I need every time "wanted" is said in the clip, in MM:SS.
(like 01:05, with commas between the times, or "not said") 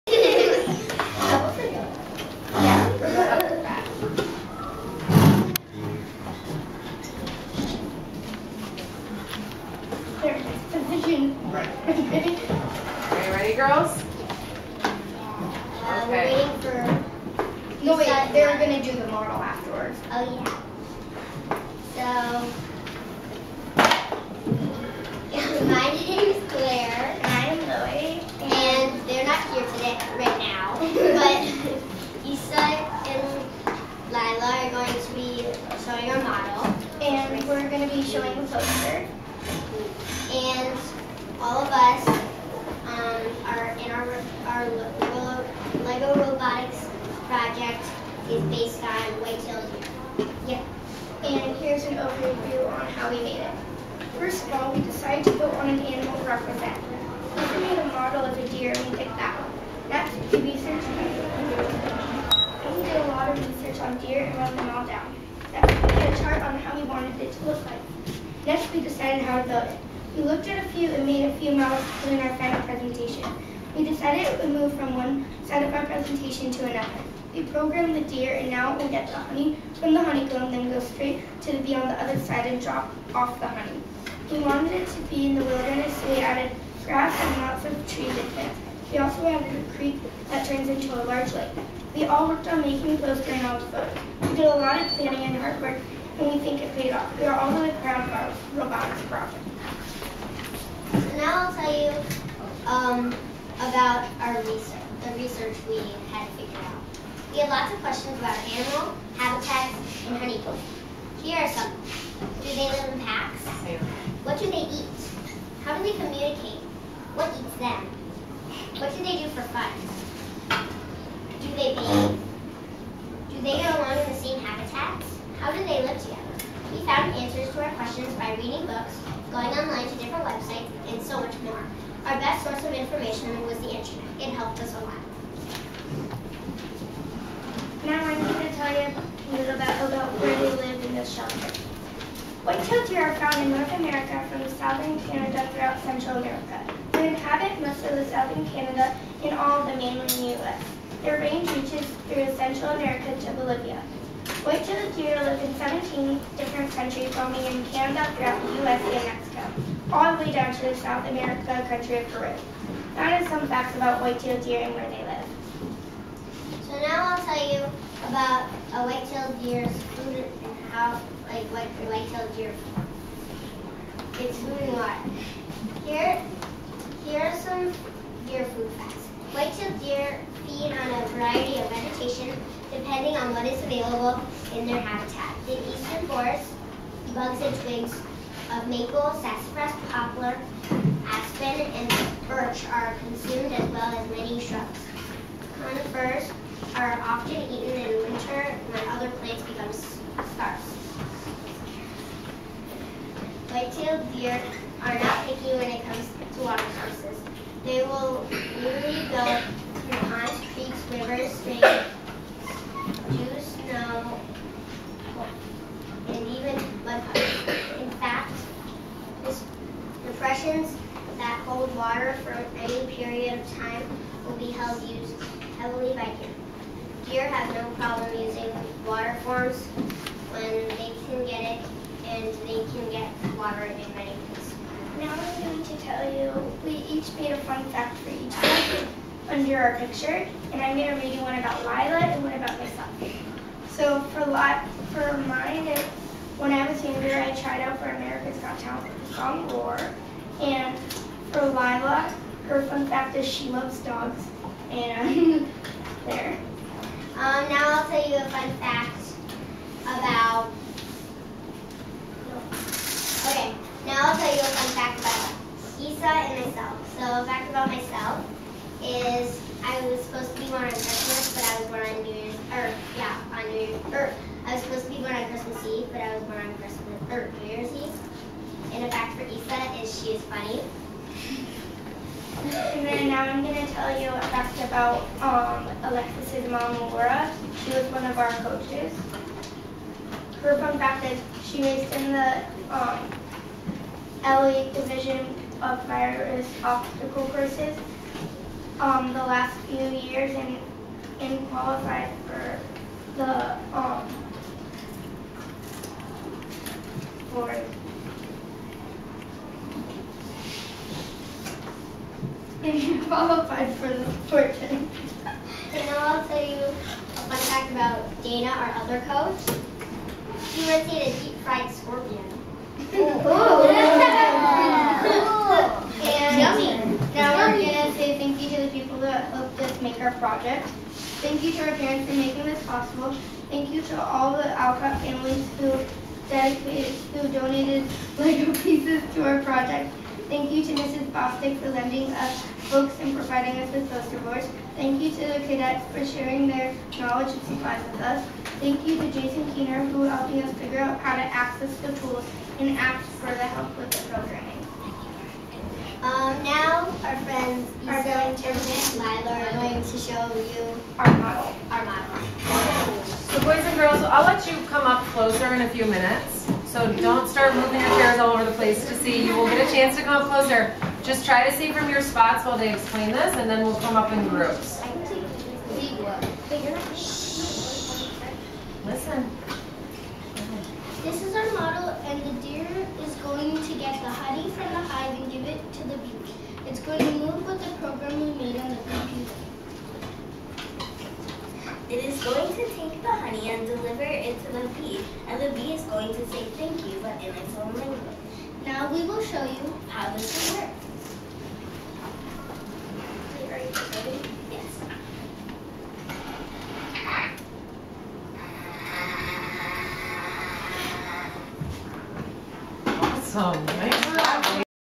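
01:06, 01:24.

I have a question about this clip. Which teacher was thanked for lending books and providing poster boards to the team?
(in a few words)
Mrs. Bostick.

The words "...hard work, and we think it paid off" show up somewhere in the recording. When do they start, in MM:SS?
01:35.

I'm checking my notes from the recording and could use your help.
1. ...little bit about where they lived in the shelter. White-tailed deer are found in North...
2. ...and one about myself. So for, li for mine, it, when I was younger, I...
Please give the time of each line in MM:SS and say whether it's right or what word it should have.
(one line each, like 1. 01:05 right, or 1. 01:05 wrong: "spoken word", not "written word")
1. 02:19 right
2. 04:02 right.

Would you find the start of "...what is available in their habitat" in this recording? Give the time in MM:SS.
03:03.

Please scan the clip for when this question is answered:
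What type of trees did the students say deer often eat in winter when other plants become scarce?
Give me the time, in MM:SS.
03:15.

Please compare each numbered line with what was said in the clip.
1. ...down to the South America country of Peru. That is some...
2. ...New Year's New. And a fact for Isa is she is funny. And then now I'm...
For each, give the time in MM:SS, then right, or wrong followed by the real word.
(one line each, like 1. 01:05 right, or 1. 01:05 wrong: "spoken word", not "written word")
1. 02:40 right
2. 04:37 wrong: "Eve", not "New".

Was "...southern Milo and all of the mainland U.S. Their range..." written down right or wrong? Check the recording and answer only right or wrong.
wrong.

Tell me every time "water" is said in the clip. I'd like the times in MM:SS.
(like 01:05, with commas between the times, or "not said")
02:54, 03:26, 03:41, 03:48, 03:53.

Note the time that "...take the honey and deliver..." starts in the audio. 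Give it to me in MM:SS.
06:32.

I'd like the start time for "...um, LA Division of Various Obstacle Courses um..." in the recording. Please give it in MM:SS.
04:52.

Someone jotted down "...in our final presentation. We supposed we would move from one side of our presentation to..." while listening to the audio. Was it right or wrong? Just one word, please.
wrong.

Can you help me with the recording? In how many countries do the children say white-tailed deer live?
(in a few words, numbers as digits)
17.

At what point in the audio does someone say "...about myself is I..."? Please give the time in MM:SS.
04:27.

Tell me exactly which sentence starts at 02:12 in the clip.
Our best source of information was the internet.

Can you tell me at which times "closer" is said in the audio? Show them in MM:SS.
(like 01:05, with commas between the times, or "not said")
06:05, 06:10.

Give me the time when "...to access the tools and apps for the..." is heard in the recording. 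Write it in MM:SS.
05:51.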